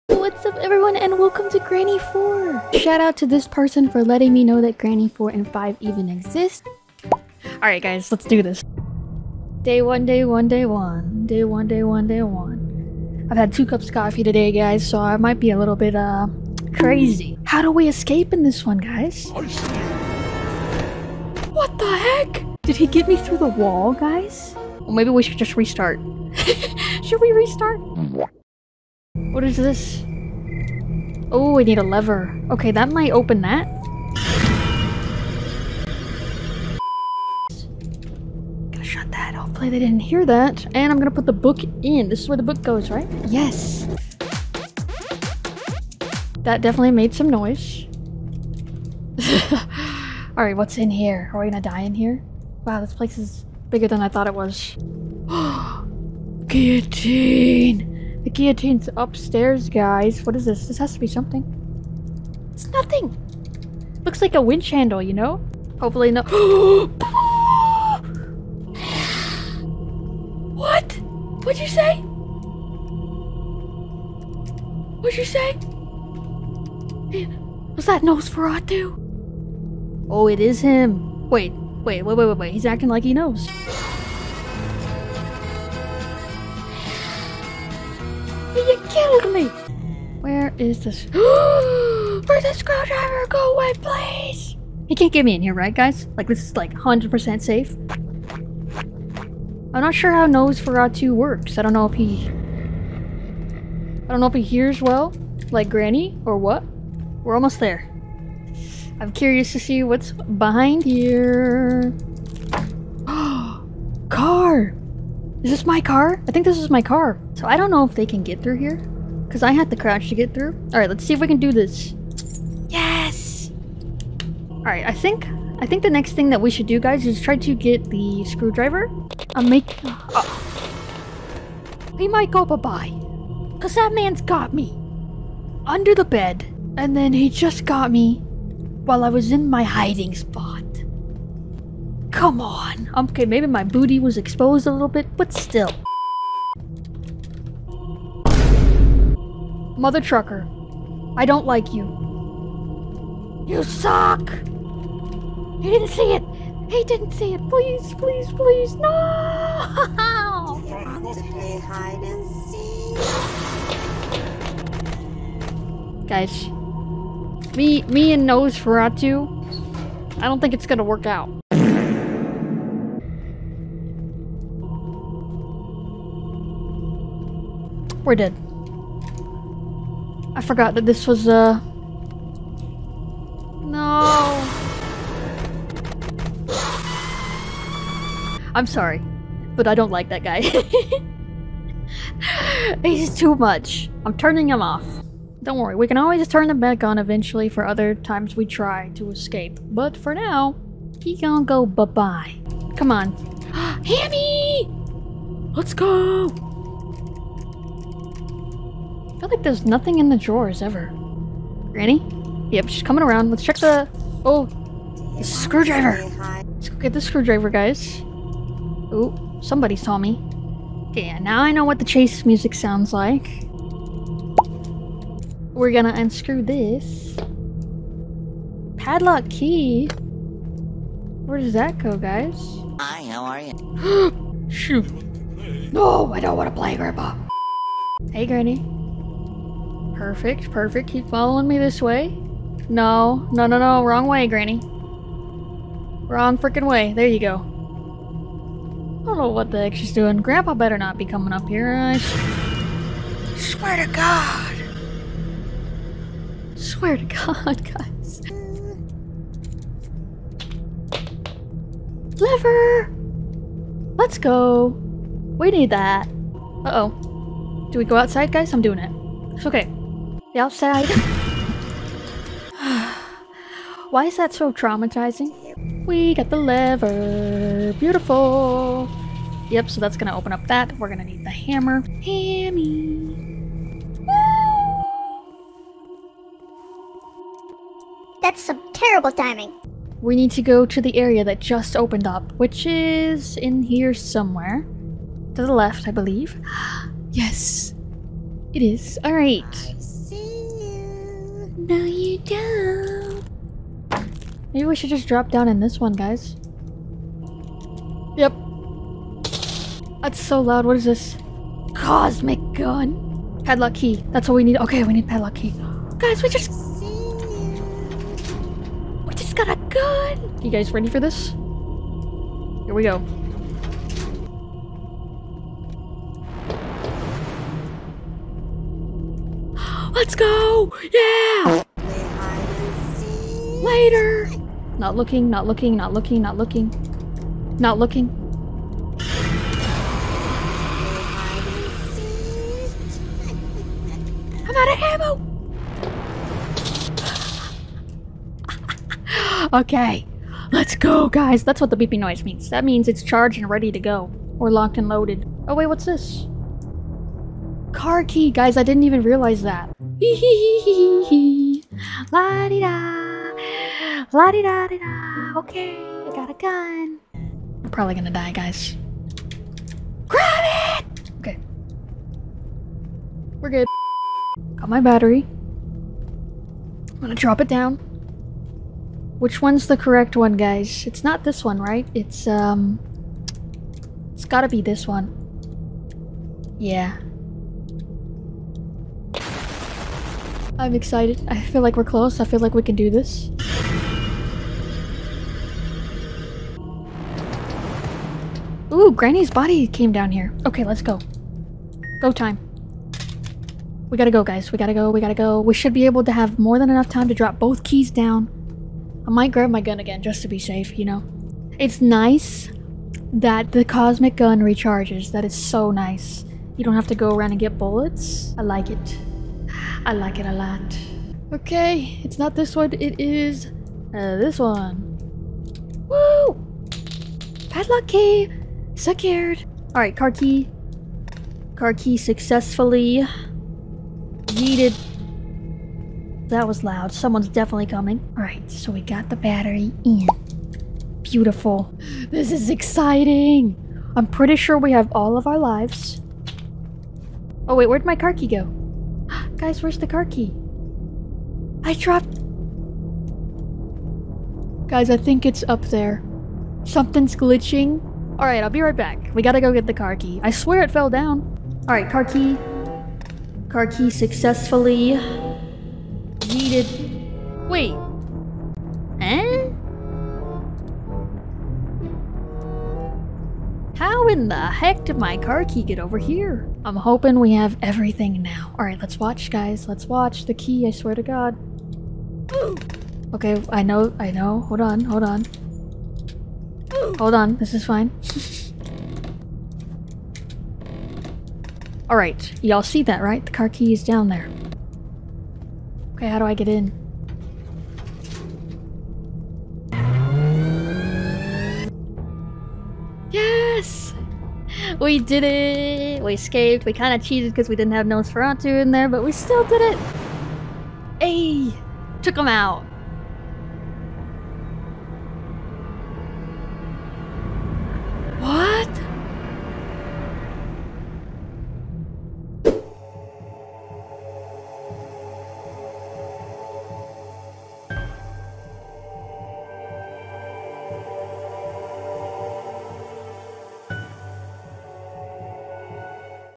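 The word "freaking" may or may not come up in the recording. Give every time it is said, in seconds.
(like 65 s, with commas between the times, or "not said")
246 s.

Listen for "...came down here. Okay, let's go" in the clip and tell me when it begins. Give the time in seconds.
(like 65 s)
399 s.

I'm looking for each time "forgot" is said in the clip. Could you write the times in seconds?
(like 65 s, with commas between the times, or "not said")
180 s.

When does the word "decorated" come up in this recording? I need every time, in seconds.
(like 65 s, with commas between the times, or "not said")
not said.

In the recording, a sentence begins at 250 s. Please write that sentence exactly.
Grandpa better not be coming up here.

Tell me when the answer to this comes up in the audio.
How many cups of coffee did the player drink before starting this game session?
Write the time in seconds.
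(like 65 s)
13 s.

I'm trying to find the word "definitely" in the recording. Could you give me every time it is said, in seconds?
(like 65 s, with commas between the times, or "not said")
46 s, 437 s.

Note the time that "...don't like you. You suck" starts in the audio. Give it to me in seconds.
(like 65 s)
151 s.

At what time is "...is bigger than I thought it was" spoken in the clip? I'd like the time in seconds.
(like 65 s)
53 s.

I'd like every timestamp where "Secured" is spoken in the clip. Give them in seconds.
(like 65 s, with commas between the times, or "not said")
428 s.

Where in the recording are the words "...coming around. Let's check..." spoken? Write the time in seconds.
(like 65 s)
212 s.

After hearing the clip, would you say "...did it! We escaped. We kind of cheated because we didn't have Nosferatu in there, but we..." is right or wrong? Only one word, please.
right.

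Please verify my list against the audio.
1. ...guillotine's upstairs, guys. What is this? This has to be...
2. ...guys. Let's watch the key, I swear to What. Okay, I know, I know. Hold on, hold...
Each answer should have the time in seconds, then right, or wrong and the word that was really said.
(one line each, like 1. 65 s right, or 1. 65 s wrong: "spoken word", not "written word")
1. 58 s right
2. 479 s wrong: "God", not "What".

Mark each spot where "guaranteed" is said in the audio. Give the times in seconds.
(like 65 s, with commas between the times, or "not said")
not said.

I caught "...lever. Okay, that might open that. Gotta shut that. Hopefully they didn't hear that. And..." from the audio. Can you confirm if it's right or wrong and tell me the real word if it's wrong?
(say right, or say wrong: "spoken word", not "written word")
right.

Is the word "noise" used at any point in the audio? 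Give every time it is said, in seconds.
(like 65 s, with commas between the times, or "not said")
47 s, 351 s.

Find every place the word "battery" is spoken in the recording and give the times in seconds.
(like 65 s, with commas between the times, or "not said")
374 s, 439 s.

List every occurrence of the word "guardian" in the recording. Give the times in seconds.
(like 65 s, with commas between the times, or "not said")
not said.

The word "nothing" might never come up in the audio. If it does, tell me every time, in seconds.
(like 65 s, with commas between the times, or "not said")
62 s, 209 s.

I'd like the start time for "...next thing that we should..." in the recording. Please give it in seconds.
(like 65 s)
125 s.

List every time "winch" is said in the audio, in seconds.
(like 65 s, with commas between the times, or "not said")
64 s.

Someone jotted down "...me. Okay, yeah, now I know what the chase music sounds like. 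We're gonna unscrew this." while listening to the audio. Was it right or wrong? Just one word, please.
right.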